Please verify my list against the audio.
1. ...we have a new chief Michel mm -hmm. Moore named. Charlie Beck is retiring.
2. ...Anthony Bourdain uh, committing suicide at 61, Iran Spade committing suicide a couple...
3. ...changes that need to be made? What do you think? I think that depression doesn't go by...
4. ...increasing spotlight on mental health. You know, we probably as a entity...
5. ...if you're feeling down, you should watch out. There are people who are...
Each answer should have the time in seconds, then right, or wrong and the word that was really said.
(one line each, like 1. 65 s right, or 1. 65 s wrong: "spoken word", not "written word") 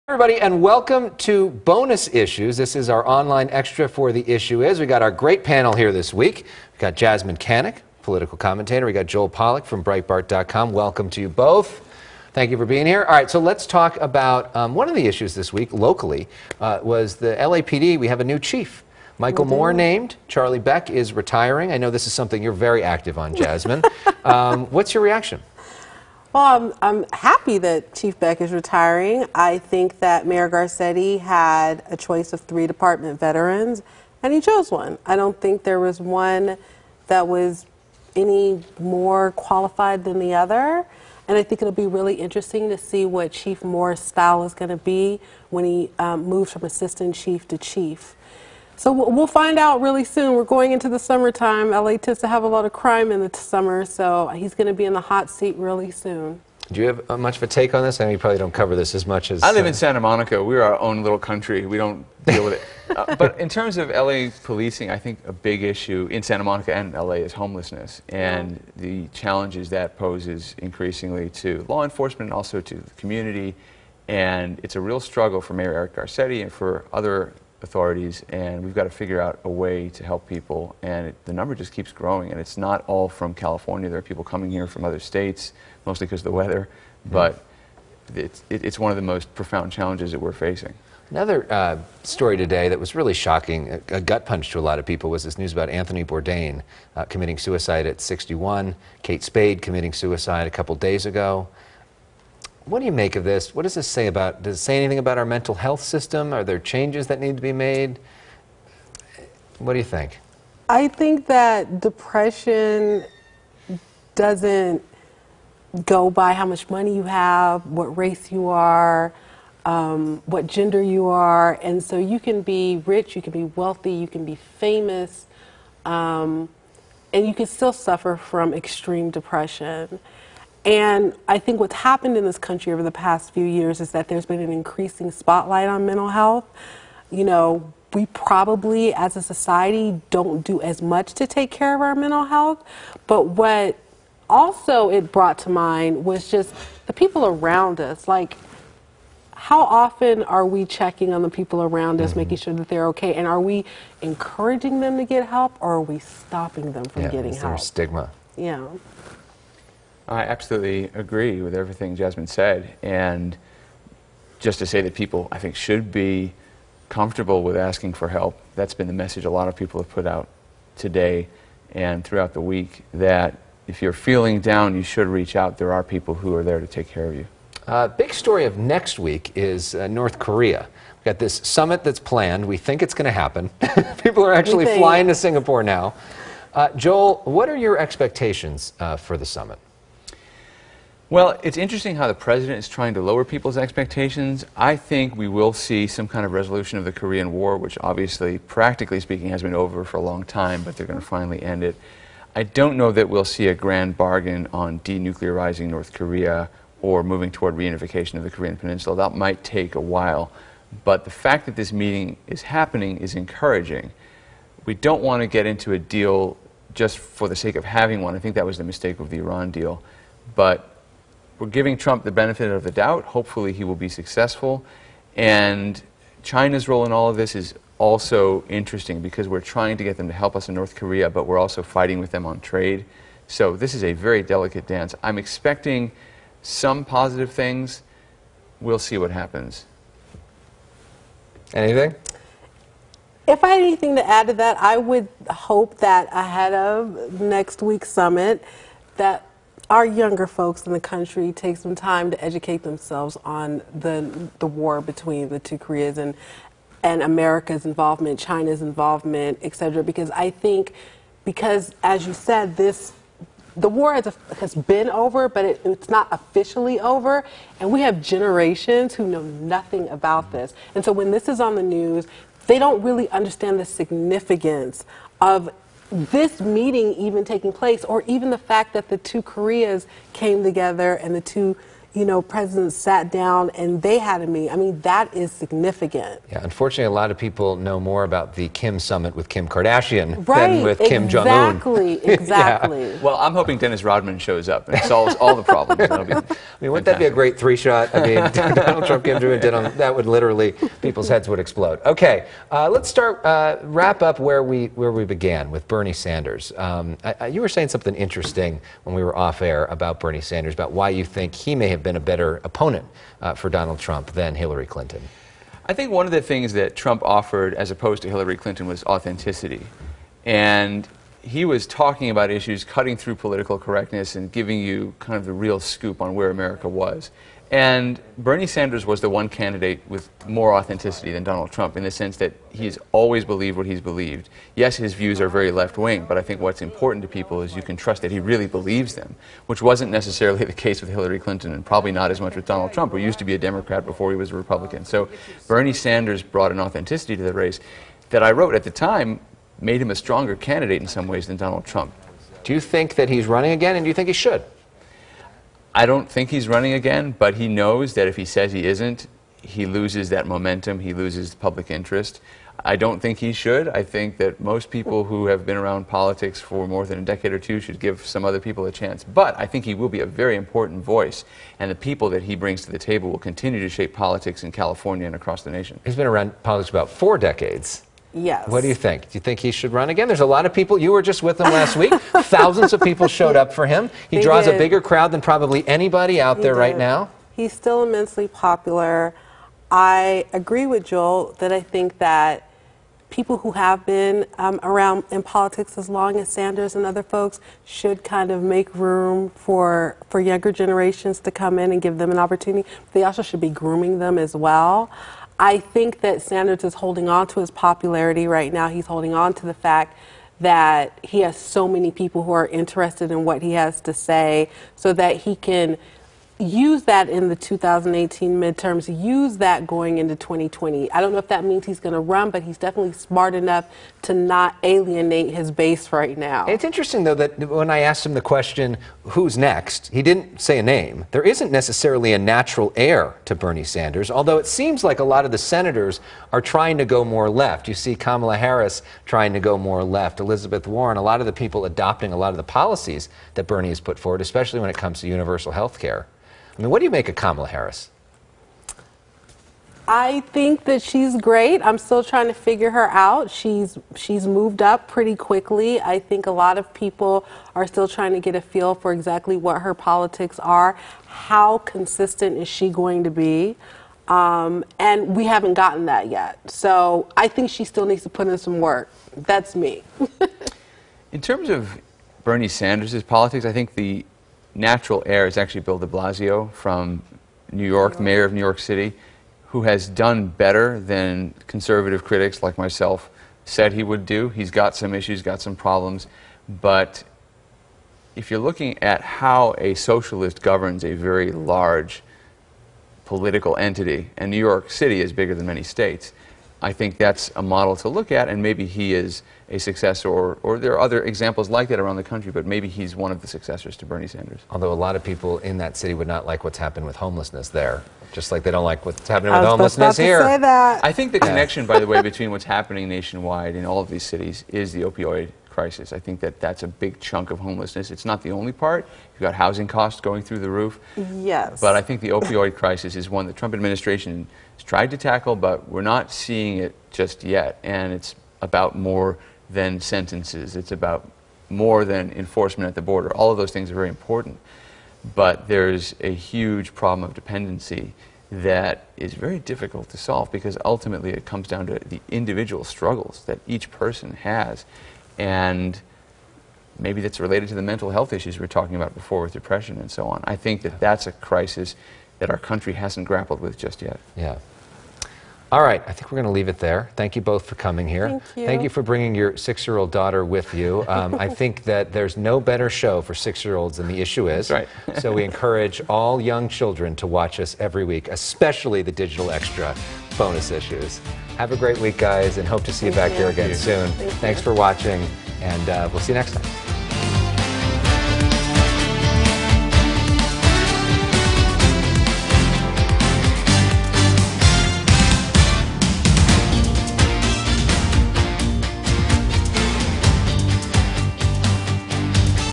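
1. 17 s right
2. 95 s wrong: "Kate", not "Iran"
3. 106 s right
4. 134 s wrong: "society", not "entity"
5. 173 s wrong: "reach", not "watch".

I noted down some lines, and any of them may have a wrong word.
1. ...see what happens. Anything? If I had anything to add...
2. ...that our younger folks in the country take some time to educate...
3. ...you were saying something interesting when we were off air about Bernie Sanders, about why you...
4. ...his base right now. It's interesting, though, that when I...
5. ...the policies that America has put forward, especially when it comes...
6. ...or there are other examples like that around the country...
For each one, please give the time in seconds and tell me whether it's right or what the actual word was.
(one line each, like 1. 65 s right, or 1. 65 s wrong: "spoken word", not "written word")
1. 238 s right
2. 248 s right
3. 307 s right
4. 425 s right
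5. 442 s wrong: "Bernie", not "America"
6. 500 s right.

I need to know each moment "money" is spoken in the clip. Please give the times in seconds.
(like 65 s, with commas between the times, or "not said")
116 s.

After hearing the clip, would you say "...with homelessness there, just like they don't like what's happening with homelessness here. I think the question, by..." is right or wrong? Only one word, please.
wrong.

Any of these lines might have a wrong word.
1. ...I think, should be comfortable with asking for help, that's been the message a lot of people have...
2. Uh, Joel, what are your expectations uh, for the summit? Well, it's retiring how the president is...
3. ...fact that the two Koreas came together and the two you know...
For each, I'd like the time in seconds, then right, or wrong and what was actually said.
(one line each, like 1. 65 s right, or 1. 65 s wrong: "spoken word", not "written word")
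1. 165 s right
2. 186 s wrong: "interesting", not "retiring"
3. 278 s right.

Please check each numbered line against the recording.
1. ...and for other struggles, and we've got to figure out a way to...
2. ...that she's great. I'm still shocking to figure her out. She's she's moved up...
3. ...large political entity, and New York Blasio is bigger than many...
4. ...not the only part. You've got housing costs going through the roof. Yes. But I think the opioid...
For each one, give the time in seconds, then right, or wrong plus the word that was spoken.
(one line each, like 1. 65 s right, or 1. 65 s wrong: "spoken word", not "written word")
1. 76 s wrong: "authorities", not "struggles"
2. 450 s wrong: "trying", not "shocking"
3. 491 s wrong: "City", not "Blasio"
4. 518 s right.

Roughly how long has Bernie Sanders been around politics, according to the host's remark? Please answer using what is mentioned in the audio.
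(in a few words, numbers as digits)
Four decades.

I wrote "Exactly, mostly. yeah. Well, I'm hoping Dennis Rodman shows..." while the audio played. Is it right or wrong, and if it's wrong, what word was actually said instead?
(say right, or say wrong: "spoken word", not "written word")
wrong: "exactly", not "mostly".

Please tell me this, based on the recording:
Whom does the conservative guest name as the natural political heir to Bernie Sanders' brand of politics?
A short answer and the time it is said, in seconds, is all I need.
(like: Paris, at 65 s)
Bill de Blasio, at 475 s.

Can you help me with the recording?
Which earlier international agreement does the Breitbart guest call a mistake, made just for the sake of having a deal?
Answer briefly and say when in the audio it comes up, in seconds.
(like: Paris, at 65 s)
Iran deal, at 219 s.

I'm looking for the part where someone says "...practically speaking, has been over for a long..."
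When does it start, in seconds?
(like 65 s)
198 s.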